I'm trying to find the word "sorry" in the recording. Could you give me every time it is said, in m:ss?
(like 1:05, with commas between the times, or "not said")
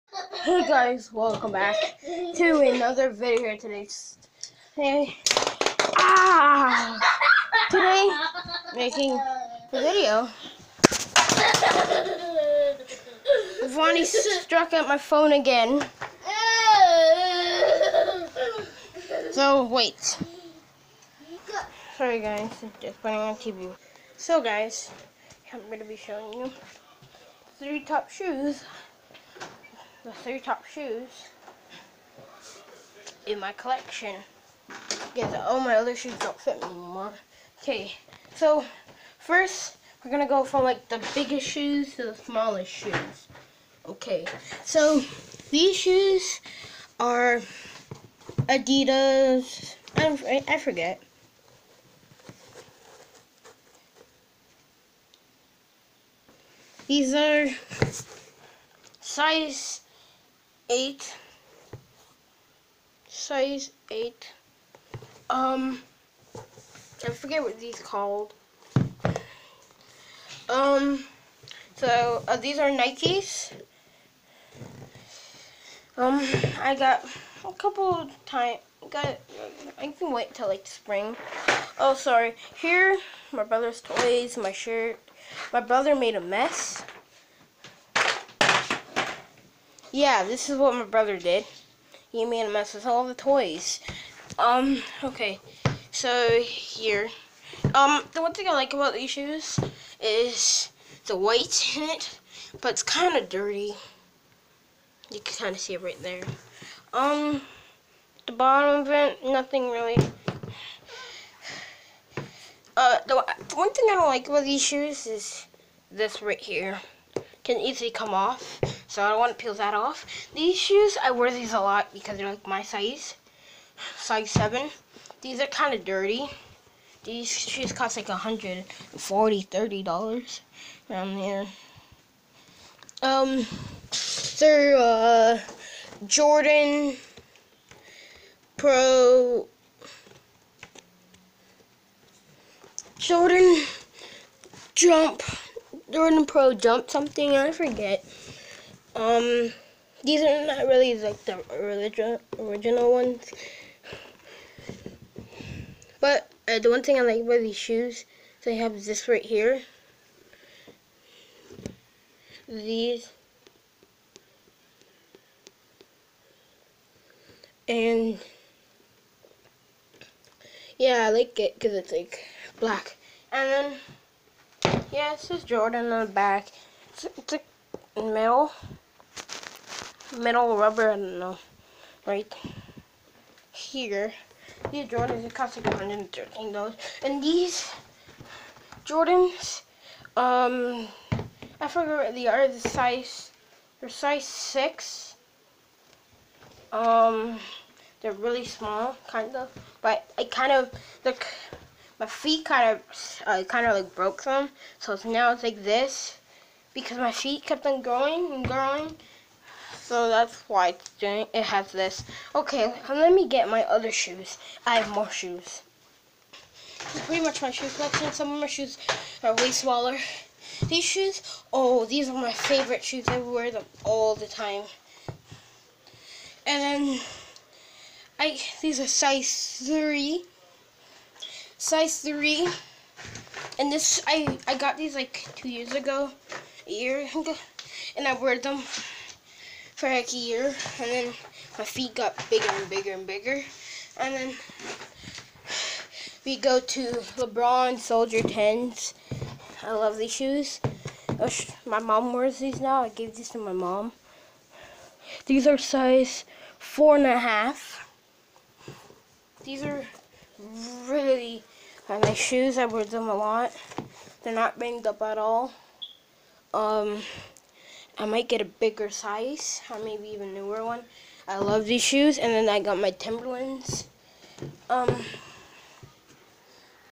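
0:21, 1:21.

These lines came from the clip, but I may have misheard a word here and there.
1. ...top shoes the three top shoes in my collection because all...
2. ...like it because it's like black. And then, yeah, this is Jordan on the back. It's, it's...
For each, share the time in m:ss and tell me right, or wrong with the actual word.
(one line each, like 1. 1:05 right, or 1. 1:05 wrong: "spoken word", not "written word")
1. 0:27 right
2. 2:51 right.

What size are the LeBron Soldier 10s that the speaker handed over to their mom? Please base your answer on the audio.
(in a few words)
4 and a half.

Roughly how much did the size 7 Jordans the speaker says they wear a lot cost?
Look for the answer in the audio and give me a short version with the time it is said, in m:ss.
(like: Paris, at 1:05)
$130, at 2:09.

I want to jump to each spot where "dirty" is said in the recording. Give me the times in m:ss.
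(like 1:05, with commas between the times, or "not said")
1:43, 2:05.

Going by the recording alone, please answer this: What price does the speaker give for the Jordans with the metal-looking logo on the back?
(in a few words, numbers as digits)
$113.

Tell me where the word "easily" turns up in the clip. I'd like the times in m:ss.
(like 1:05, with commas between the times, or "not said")
1:57.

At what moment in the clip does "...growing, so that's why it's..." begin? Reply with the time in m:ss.
3:28.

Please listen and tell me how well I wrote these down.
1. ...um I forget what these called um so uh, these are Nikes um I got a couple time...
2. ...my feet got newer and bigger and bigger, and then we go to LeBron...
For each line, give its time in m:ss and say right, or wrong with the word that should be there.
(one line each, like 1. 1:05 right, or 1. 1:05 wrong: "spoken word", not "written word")
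1. 1:05 right
2. 4:01 wrong: "bigger", not "newer".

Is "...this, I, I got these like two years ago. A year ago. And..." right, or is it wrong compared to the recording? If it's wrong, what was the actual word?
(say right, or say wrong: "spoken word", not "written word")
right.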